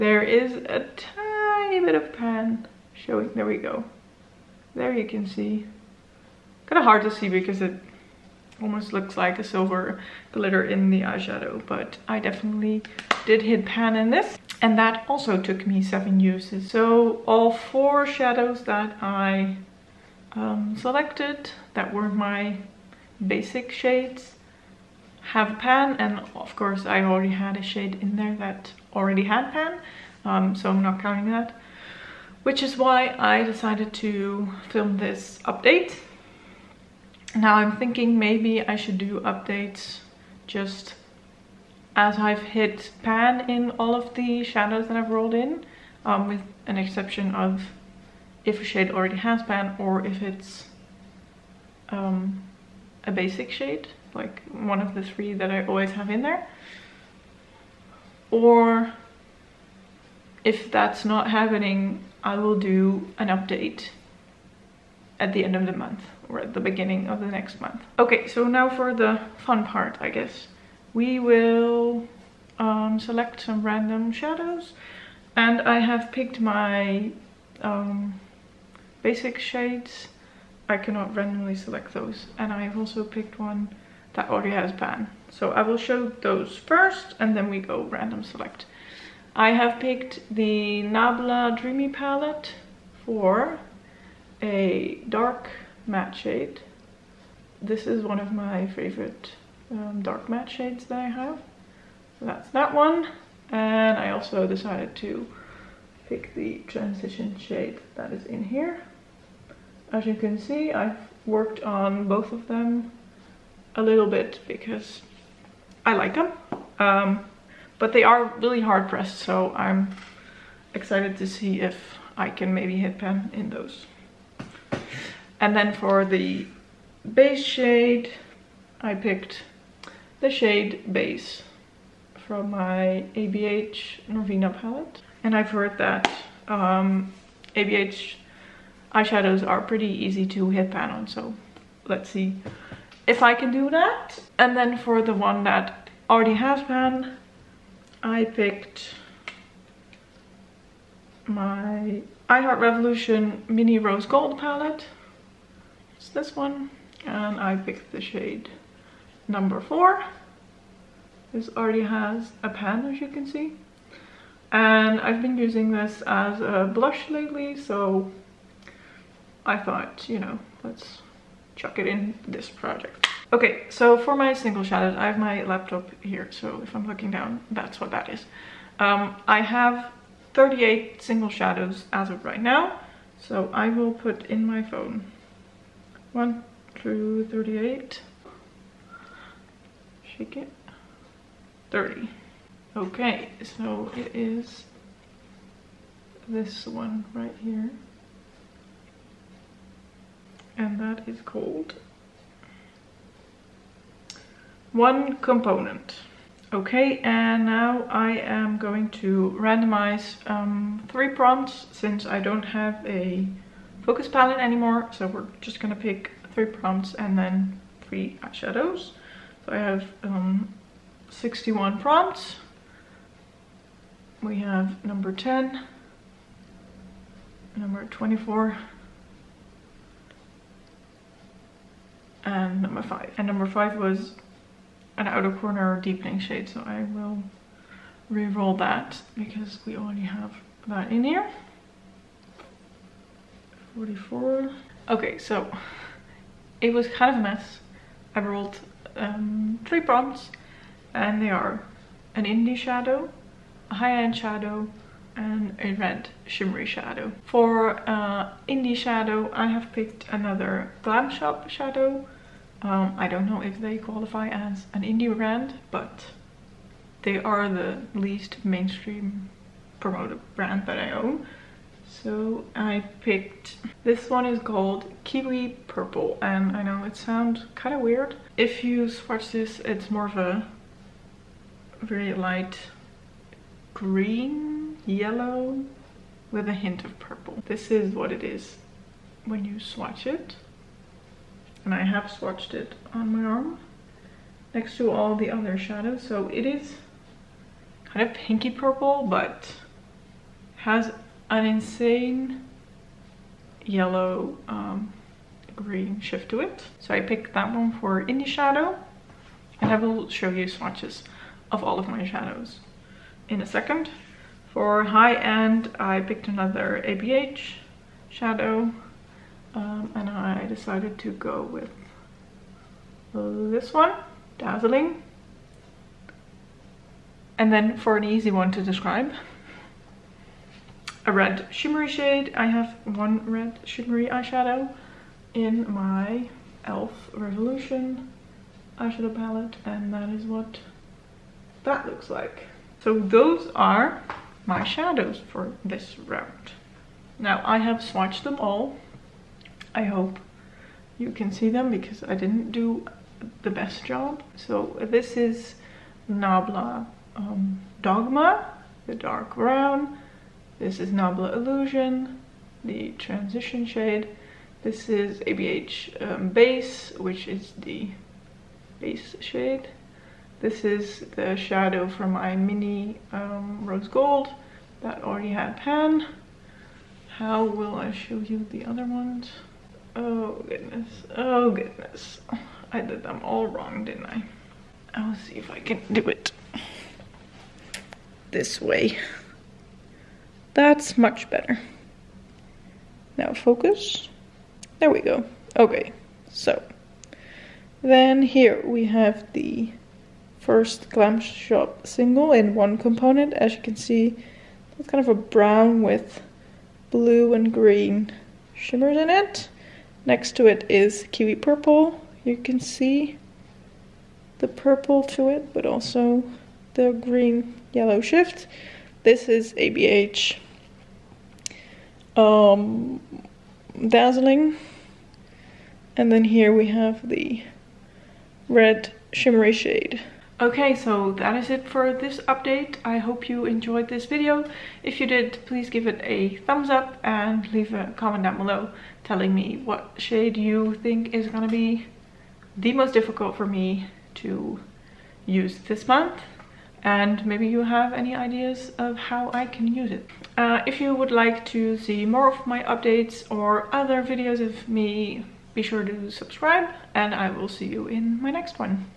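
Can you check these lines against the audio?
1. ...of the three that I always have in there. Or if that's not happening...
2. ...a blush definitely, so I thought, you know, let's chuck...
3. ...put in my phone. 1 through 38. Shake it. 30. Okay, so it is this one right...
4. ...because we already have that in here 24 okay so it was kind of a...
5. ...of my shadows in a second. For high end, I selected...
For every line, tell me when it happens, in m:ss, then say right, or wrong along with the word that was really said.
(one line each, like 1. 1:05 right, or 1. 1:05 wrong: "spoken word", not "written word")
1. 0:54 right
2. 2:46 wrong: "lately", not "definitely"
3. 3:03 right
4. 3:59 wrong: "44", not "24"
5. 5:11 wrong: "picked", not "selected".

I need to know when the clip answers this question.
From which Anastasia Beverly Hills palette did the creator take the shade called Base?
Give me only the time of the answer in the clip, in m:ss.
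2:13.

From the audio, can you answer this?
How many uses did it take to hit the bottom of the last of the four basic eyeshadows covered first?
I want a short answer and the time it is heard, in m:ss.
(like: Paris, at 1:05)
7, at 0:15.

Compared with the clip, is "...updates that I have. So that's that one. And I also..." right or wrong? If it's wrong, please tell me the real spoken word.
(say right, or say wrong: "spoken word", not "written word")
wrong: "shades", not "updates".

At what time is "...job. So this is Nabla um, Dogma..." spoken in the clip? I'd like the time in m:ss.
5:53.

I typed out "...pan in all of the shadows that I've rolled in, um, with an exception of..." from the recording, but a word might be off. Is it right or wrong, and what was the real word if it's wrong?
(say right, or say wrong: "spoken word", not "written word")
right.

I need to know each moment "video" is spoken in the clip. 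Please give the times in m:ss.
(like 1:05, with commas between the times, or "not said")
7:14, 7:34.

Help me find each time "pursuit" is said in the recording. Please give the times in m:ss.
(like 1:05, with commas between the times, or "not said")
not said.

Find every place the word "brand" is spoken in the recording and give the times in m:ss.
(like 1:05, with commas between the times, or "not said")
4:25, 4:30.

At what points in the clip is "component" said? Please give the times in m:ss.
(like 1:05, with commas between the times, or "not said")
3:25, 6:42.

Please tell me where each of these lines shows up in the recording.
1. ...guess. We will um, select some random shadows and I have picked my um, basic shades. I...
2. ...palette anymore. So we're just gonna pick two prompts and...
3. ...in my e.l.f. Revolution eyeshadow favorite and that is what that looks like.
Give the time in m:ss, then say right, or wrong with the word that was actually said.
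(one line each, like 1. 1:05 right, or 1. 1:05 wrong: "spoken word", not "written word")
1. 1:10 right
2. 3:34 wrong: "three", not "two"
3. 5:35 wrong: "palette", not "favorite".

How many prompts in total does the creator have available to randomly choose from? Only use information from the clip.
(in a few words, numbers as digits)
61.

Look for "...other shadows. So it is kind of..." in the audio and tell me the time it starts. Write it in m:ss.
4:55.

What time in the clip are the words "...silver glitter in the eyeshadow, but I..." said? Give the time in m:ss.
0:09.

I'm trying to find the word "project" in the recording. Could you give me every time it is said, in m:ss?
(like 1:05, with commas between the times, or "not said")
2:52.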